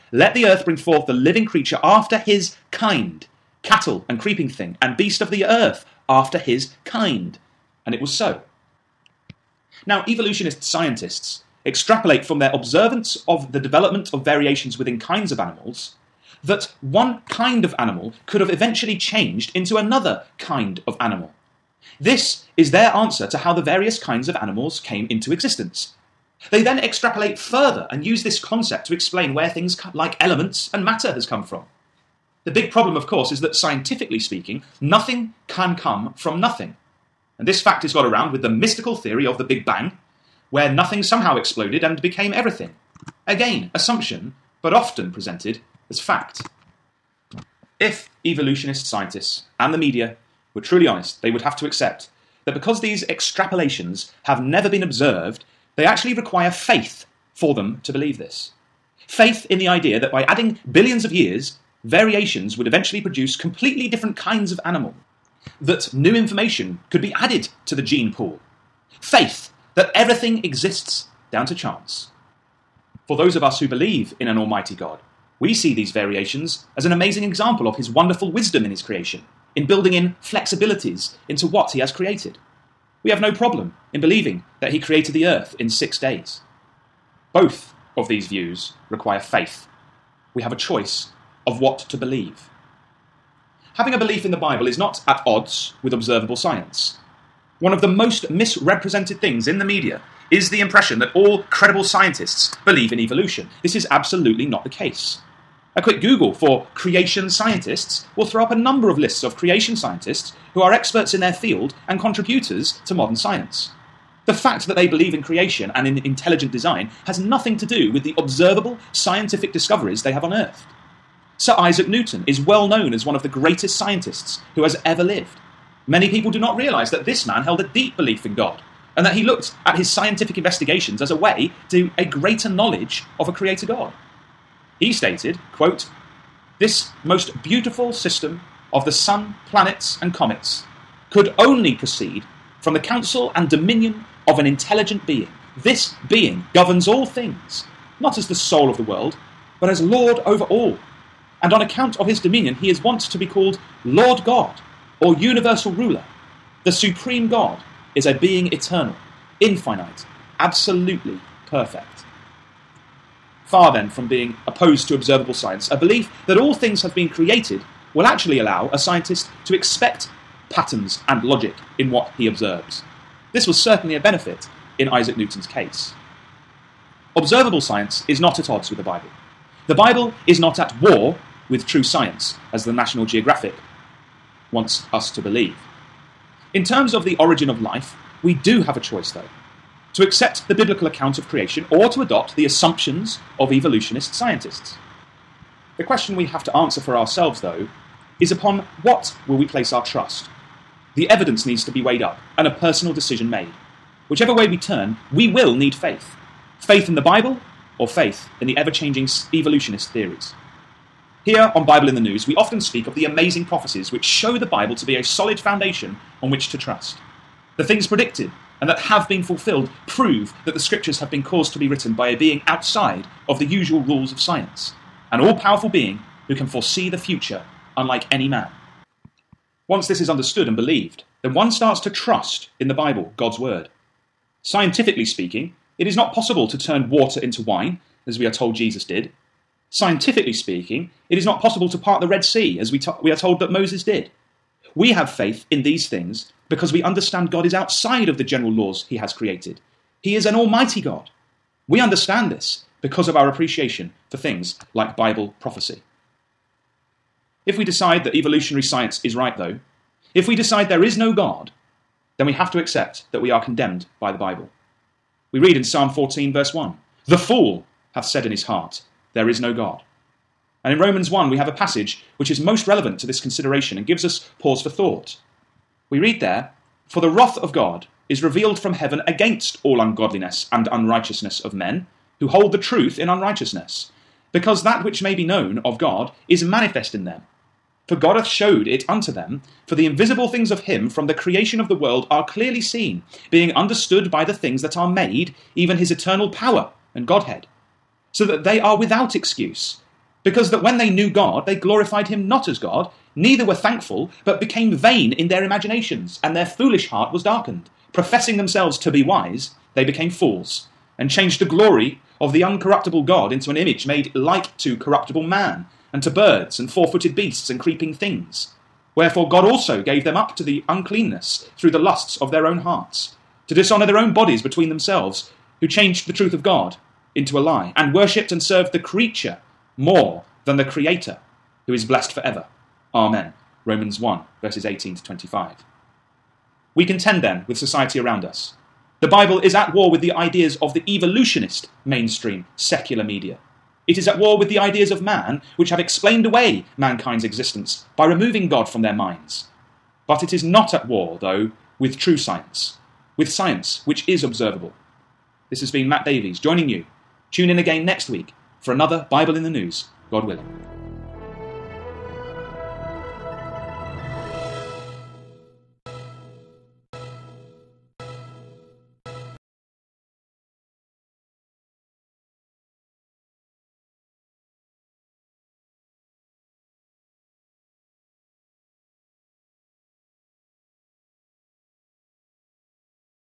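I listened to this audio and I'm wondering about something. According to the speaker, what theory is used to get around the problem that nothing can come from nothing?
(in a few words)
The Big Bang.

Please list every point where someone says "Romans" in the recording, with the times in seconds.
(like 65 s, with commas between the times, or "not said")
270 s, 333 s.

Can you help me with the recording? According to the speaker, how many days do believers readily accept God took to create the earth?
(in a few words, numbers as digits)
6.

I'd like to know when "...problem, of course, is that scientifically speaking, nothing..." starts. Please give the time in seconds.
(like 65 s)
32 s.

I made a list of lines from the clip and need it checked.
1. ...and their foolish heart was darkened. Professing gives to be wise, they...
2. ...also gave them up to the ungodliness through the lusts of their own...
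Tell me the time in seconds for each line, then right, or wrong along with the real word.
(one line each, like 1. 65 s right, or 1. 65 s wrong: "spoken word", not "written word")
1. 306 s wrong: "themselves", not "gives"
2. 319 s wrong: "uncleanness", not "ungodliness".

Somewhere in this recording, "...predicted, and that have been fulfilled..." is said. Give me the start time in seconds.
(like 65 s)
217 s.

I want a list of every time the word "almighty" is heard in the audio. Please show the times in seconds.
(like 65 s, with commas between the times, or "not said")
74 s, 250 s.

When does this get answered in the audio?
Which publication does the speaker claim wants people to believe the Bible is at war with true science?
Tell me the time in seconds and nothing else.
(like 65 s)
182 s.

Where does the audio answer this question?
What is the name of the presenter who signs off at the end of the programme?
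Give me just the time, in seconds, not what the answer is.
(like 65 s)
355 s.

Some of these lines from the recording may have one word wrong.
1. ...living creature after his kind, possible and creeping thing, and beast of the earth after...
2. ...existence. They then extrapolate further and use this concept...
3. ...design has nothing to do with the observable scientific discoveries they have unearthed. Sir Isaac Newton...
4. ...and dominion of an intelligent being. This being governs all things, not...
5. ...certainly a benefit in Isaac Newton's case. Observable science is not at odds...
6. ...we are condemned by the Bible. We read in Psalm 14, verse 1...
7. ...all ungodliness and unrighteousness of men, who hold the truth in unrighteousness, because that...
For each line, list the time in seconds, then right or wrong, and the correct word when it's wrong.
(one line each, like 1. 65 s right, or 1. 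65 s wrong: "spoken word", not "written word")
1. 1 s wrong: "cattle", not "possible"
2. 25 s right
3. 116 s right
4. 143 s right
5. 173 s right
6. 263 s right
7. 279 s right.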